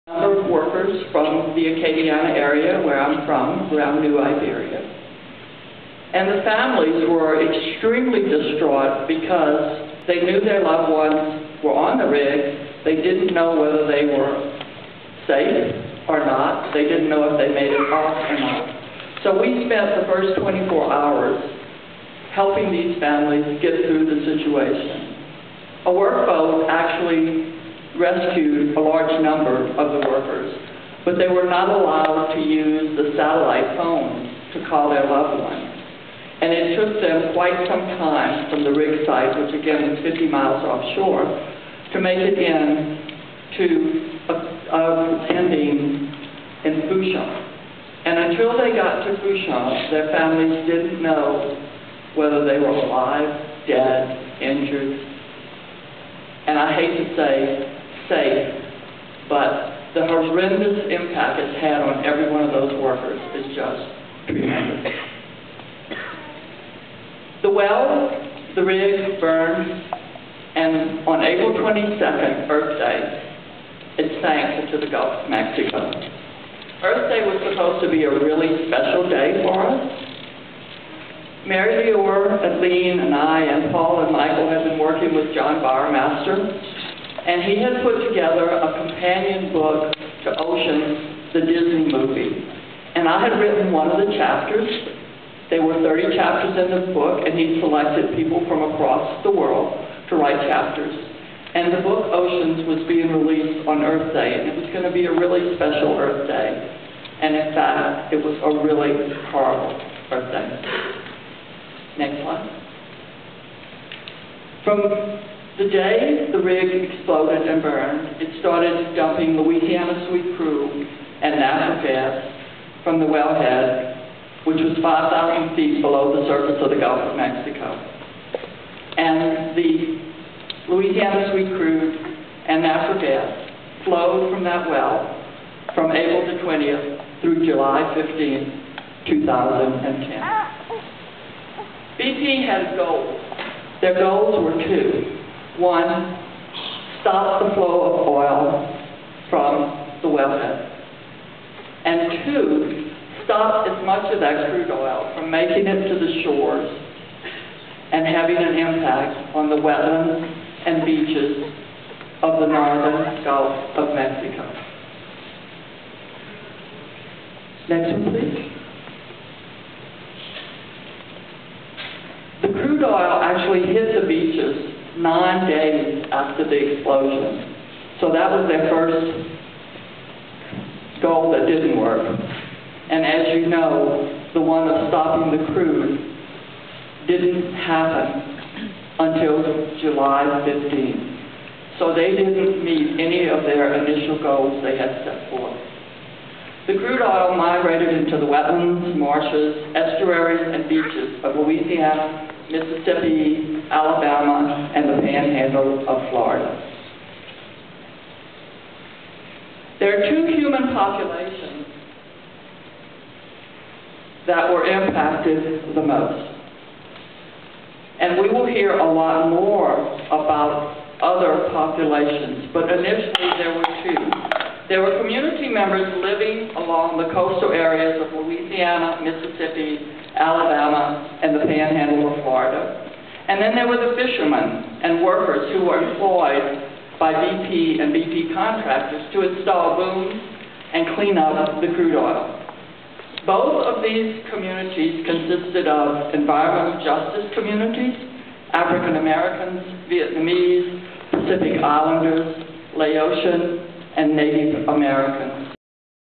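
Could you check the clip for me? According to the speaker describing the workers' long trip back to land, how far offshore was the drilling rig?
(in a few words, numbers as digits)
50 miles.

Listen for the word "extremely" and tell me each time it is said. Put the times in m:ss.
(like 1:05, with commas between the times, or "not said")
0:07.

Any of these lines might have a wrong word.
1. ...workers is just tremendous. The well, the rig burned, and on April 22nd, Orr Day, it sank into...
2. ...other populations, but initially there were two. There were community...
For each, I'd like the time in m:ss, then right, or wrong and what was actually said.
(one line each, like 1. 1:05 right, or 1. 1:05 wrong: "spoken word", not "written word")
1. 1:02 wrong: "Earth", not "Orr"
2. 3:41 right.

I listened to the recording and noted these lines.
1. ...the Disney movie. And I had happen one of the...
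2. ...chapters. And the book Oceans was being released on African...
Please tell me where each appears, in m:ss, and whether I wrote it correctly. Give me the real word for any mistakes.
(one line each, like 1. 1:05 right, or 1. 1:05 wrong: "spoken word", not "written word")
1. 1:31 wrong: "written", not "happen"
2. 1:40 wrong: "Earth", not "African".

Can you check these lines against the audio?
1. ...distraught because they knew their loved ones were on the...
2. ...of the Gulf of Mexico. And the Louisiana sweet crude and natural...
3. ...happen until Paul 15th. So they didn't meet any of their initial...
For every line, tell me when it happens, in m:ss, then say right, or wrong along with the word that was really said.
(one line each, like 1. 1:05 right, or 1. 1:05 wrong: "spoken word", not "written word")
1. 0:08 right
2. 2:06 right
3. 3:07 wrong: "July", not "Paul".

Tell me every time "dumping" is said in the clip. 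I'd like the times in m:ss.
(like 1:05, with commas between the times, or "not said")
1:58.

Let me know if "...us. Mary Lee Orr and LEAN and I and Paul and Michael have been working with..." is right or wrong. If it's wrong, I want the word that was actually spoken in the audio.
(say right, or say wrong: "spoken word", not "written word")
right.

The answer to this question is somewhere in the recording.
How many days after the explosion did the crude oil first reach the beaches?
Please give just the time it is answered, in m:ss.
2:54.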